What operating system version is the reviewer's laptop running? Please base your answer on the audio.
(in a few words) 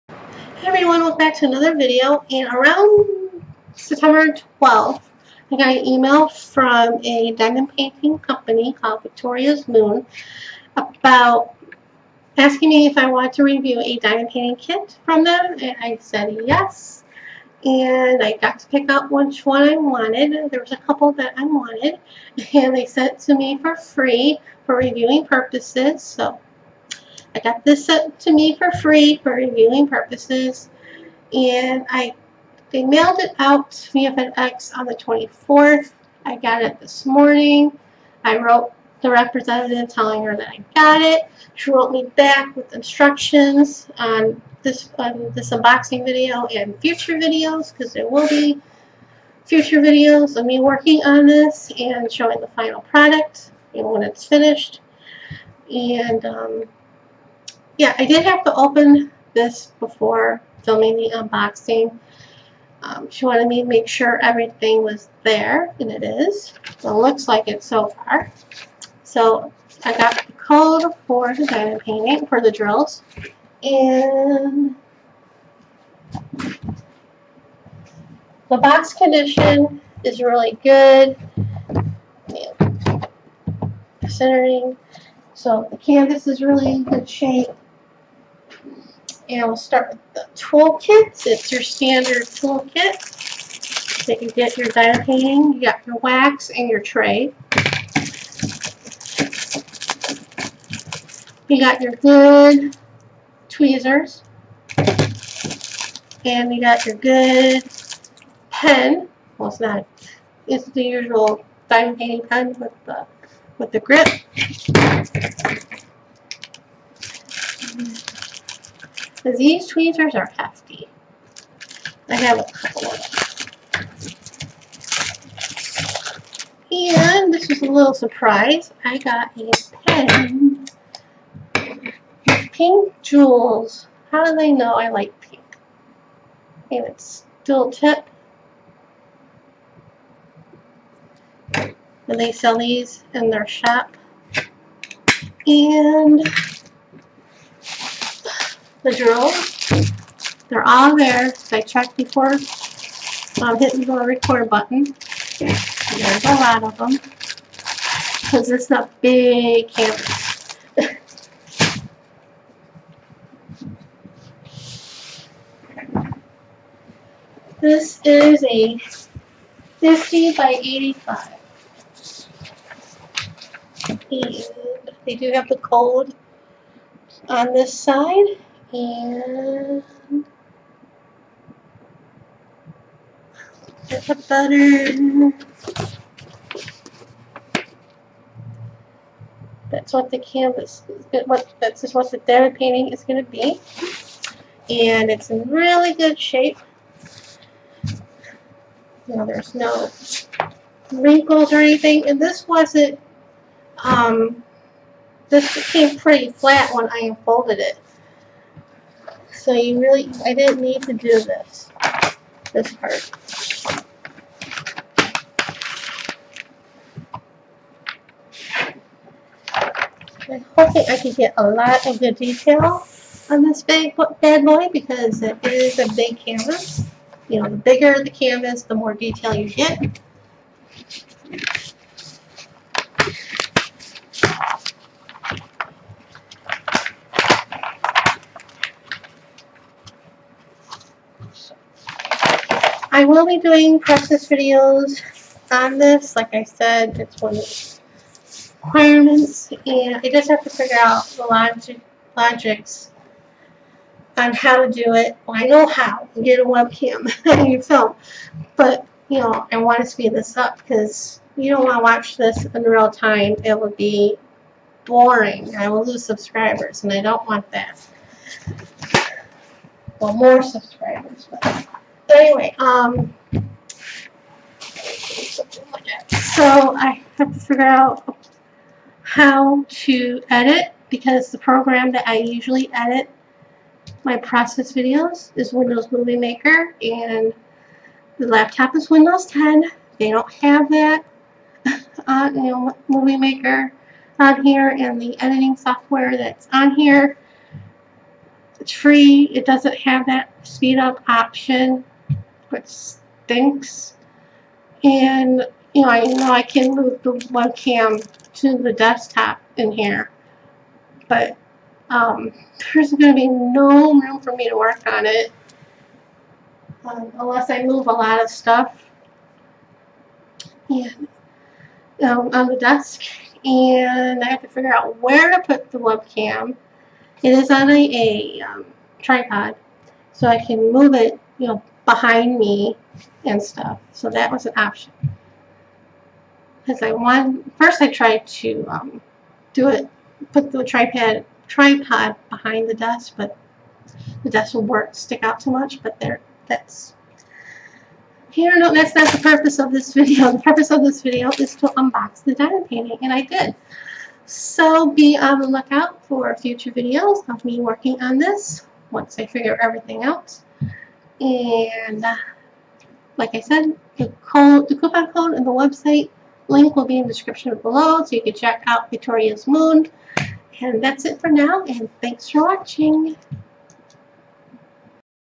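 Windows 10.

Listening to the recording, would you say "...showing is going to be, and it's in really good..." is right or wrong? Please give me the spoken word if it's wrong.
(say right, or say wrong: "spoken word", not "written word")
wrong: "painting", not "showing".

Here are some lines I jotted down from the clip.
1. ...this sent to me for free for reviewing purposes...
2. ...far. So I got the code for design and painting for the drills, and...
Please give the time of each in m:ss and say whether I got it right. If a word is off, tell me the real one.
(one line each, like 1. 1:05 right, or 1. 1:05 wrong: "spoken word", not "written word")
1. 0:27 right
2. 1:07 right.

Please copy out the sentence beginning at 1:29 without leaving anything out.
And we'll start with the toolkits.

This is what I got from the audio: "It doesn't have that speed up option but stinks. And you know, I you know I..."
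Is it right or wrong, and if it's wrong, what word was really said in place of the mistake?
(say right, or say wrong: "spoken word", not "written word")
right.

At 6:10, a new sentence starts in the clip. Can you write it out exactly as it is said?
And that's it for now, and thanks for watching.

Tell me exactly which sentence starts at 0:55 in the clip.
And um, yeah, I did have to open this before filming the unboxing.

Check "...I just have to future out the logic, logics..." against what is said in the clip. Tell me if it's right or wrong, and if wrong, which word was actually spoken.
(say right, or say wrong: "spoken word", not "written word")
wrong: "figure", not "future".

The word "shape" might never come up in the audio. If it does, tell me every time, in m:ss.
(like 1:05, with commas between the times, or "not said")
1:27, 3:16.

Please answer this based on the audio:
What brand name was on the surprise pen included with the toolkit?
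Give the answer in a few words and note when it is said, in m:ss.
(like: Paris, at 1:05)
Pink Jewels, at 2:12.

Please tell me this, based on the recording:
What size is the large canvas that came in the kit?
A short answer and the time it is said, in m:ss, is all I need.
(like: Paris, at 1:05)
50 by 85, at 2:49.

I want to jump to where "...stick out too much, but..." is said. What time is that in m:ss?
5:44.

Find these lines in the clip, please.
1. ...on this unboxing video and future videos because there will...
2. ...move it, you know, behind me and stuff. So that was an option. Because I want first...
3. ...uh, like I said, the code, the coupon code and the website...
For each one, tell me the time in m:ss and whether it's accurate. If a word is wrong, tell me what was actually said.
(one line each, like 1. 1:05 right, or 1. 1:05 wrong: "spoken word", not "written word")
1. 0:44 right
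2. 5:30 right
3. 6:02 right.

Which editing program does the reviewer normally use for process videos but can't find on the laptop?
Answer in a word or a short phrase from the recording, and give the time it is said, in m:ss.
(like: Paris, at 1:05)
Windows Movie Maker, at 4:45.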